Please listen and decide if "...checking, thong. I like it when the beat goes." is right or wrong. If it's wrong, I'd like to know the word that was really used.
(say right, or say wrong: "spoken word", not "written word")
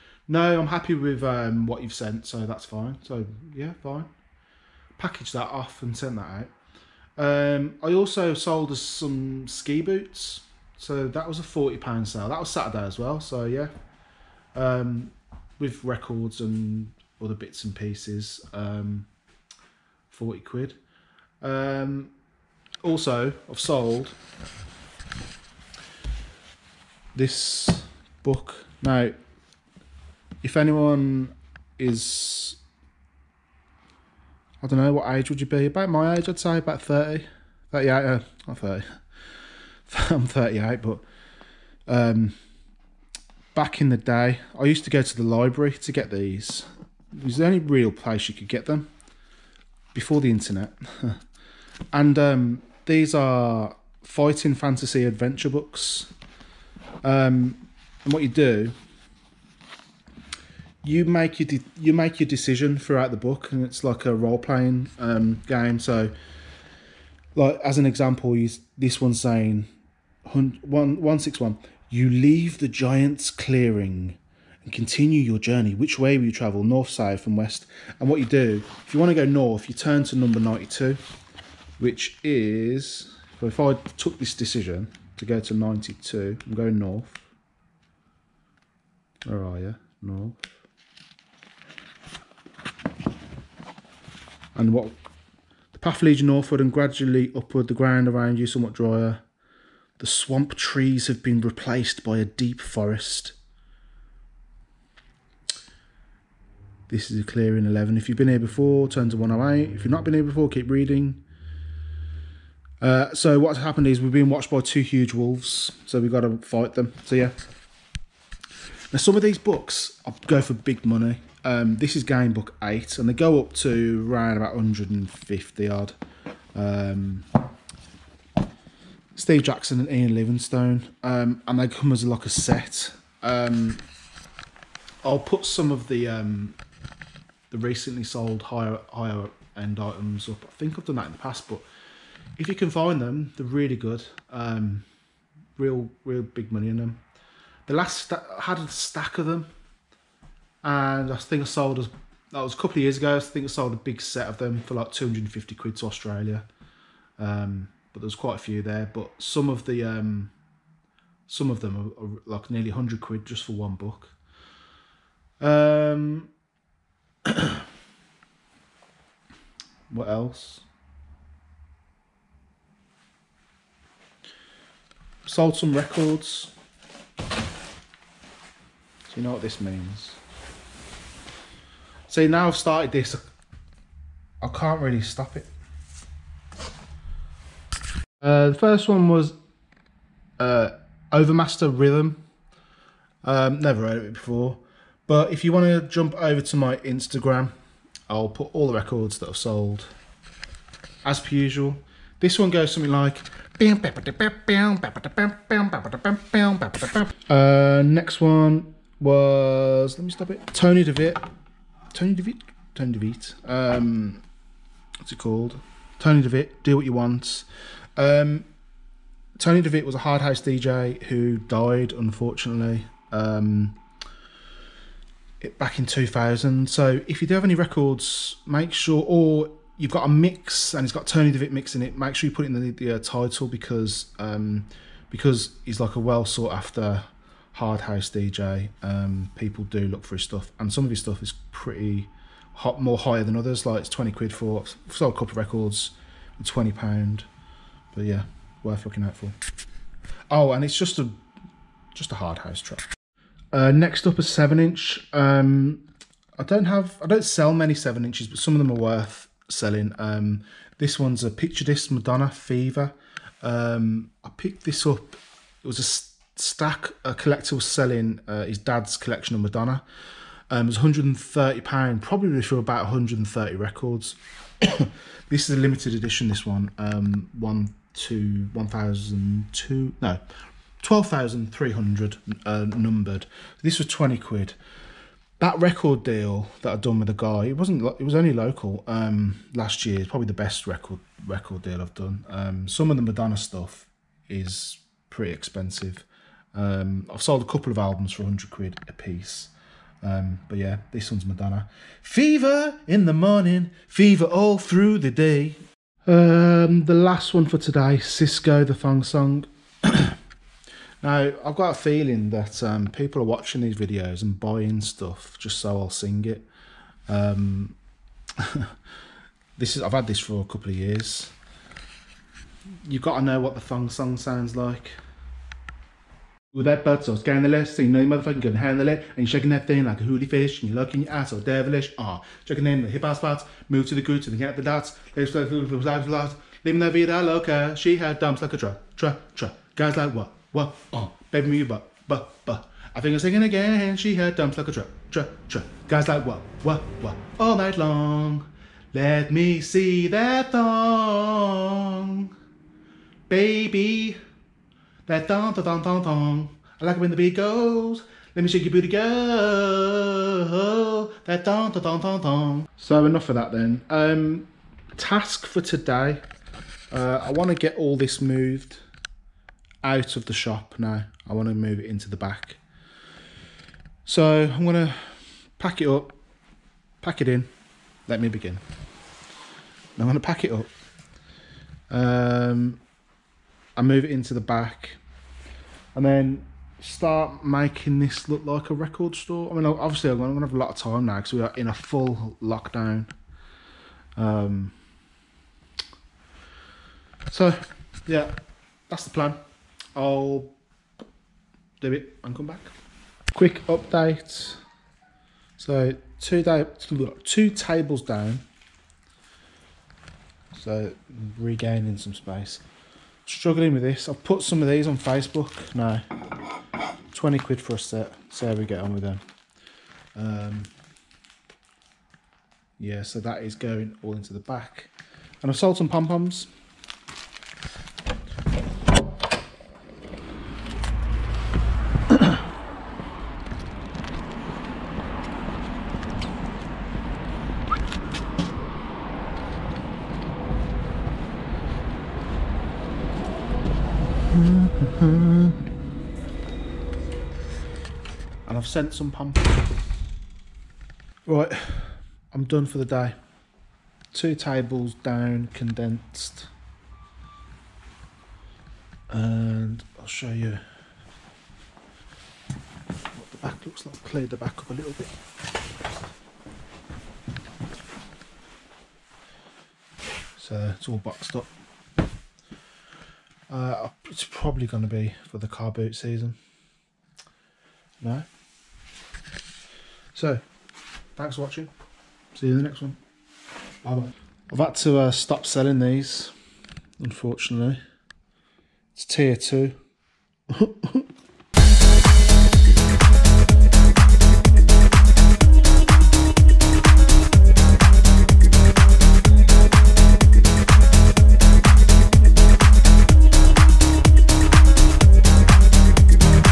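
wrong: "thong", not "checking".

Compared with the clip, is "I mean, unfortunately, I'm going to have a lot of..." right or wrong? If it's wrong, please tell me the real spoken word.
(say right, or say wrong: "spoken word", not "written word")
wrong: "obviously", not "unfortunately".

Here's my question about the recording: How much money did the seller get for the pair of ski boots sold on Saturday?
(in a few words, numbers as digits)
£40.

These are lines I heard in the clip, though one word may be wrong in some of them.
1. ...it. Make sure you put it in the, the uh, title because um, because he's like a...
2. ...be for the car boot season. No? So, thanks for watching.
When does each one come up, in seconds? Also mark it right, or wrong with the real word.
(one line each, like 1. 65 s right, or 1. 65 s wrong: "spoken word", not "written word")
1. 231 s right
2. 474 s right.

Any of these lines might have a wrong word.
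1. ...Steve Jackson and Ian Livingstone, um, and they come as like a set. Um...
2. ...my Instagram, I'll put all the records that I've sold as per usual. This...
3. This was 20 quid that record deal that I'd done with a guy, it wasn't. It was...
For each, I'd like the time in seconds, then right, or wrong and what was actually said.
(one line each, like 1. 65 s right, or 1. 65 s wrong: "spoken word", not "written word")
1. 129 s right
2. 196 s right
3. 283 s right.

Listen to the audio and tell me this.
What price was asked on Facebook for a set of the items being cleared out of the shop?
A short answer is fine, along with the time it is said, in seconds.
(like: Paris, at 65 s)
£20, at 417 s.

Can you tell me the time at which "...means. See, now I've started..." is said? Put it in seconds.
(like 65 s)
179 s.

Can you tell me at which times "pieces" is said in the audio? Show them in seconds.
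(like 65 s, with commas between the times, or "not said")
17 s, 298 s.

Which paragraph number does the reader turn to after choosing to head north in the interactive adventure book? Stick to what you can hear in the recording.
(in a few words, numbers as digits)
92.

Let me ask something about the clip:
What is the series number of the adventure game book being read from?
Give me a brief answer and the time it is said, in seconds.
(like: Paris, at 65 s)
8, at 122 s.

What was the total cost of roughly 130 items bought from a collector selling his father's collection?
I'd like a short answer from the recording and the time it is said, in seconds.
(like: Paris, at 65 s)
£130, at 270 s.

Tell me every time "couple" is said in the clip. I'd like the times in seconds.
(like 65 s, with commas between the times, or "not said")
152 s, 245 s, 297 s, 320 s.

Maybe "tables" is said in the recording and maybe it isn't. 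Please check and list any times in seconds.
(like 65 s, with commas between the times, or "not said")
407 s, 454 s.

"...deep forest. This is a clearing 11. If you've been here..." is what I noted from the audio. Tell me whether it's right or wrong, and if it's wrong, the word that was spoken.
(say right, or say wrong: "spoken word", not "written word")
right.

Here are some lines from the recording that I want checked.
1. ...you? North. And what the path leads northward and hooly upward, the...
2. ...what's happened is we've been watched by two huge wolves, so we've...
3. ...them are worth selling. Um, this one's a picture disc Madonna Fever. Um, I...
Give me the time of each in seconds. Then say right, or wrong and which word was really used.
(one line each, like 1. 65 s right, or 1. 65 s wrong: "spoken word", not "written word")
1. 89 s wrong: "gradually", not "hooly"
2. 113 s right
3. 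258 s right.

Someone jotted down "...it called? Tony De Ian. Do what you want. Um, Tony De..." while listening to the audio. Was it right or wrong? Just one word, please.
wrong.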